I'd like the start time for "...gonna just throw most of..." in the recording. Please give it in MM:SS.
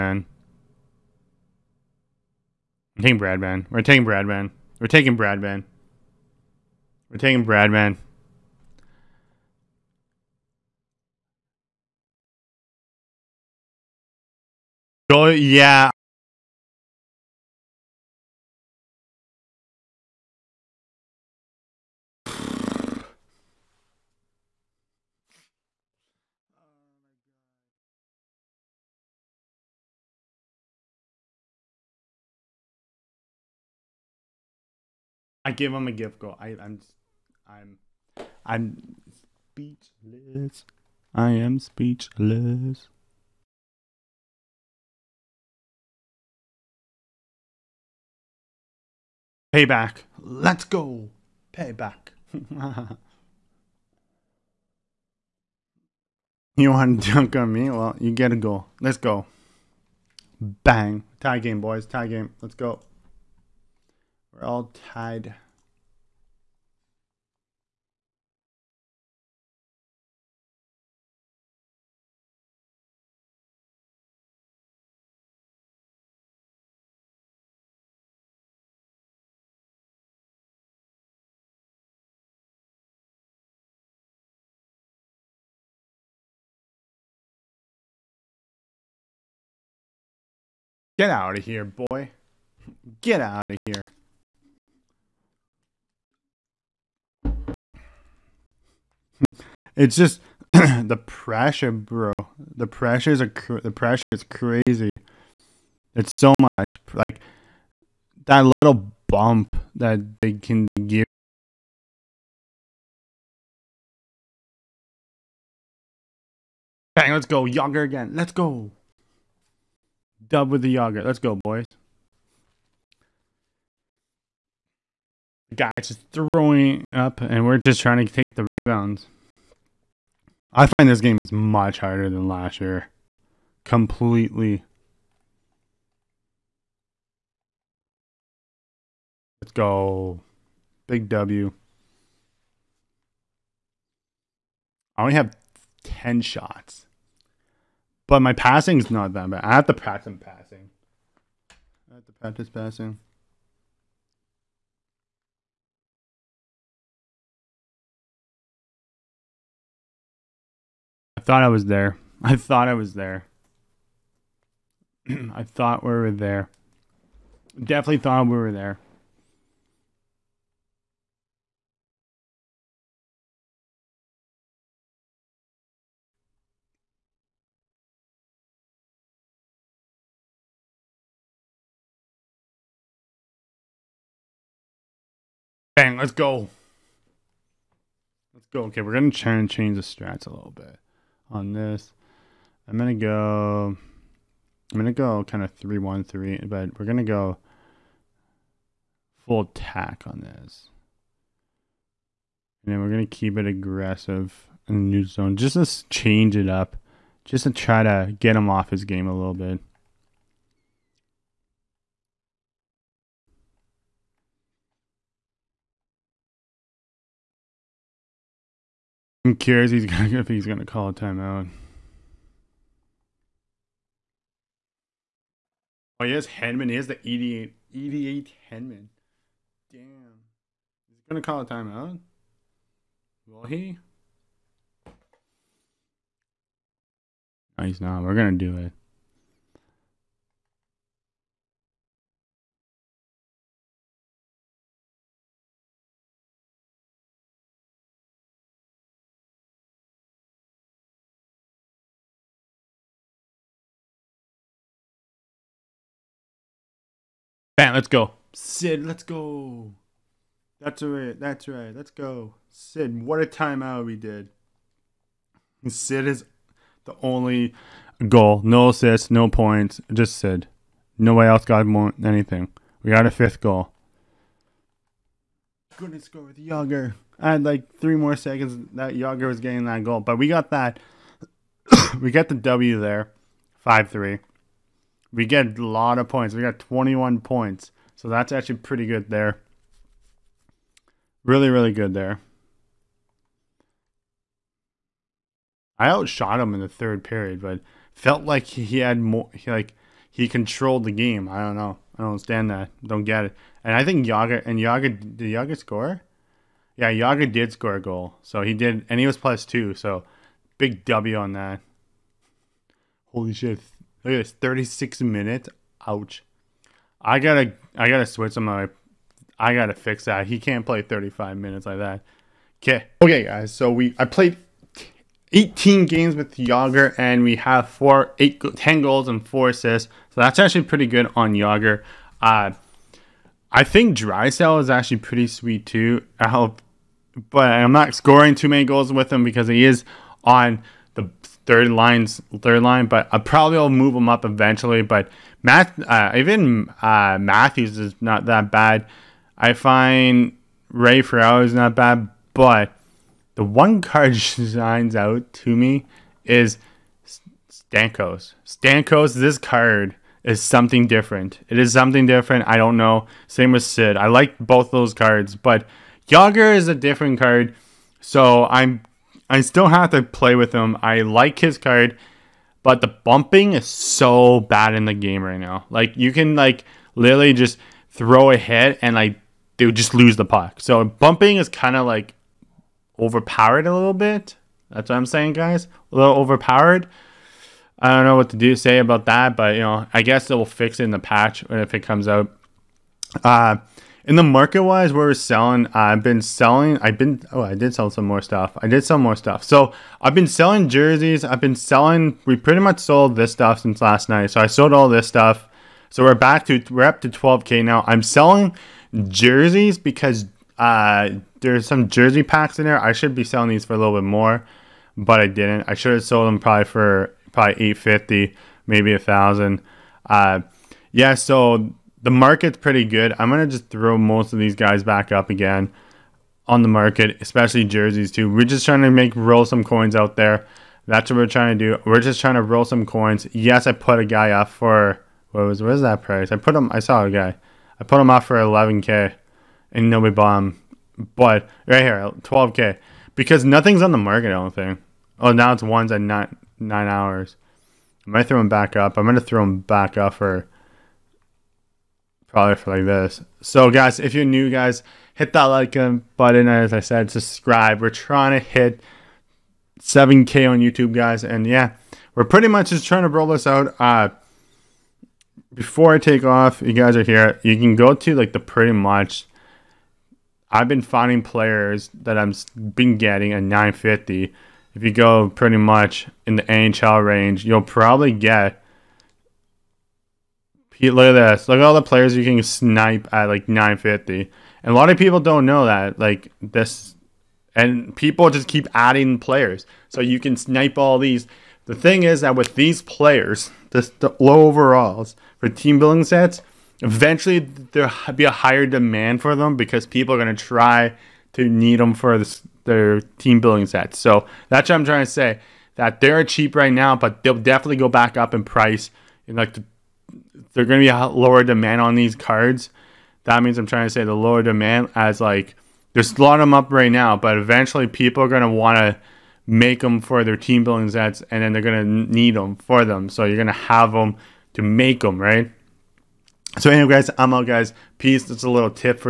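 07:03.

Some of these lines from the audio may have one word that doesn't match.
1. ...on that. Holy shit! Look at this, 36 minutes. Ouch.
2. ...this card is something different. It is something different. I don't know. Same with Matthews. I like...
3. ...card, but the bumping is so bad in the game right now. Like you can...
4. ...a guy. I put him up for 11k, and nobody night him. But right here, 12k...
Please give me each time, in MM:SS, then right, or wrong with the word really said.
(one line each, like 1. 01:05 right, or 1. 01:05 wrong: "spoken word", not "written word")
1. 05:11 right
2. 05:59 wrong: "Sid", not "Matthews"
3. 06:11 right
4. 07:17 wrong: "bought", not "night".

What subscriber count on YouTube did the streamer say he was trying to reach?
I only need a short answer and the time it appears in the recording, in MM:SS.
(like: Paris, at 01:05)
7K, at 07:39.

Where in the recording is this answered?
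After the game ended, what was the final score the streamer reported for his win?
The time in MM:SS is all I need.
04:43.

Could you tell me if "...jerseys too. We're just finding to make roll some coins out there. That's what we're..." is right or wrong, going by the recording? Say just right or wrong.
wrong.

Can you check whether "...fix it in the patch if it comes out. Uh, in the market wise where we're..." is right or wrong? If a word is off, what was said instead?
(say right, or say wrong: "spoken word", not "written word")
right.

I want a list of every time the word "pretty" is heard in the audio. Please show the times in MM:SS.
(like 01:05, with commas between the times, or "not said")
04:48, 05:30, 05:34, 06:42, 07:02, 07:42, 07:48, 07:55.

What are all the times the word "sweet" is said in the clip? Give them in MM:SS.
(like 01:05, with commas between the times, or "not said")
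05:35.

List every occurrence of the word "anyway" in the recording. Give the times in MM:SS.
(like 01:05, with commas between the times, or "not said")
08:46.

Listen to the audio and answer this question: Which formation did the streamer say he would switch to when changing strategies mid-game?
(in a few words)
3-1-3.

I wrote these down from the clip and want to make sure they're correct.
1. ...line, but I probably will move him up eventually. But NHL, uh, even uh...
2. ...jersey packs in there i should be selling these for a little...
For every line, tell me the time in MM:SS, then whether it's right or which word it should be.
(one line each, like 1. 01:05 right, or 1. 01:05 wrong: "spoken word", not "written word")
1. 05:42 wrong: "Math", not "NHL"
2. 06:51 right.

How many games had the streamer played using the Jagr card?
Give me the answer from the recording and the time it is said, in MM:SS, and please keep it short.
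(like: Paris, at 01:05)
18, at 05:25.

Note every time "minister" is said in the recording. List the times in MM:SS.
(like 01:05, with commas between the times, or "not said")
not said.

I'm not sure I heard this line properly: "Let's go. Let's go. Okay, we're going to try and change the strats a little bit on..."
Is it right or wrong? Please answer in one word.
right.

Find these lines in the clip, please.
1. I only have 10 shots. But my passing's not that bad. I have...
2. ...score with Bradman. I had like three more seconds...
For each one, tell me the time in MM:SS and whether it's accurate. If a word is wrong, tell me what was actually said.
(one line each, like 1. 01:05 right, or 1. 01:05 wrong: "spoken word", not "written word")
1. 02:24 right
2. 04:36 wrong: "Jagr", not "Bradman".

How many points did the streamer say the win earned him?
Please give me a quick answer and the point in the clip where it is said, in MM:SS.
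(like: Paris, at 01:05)
21, at 04:46.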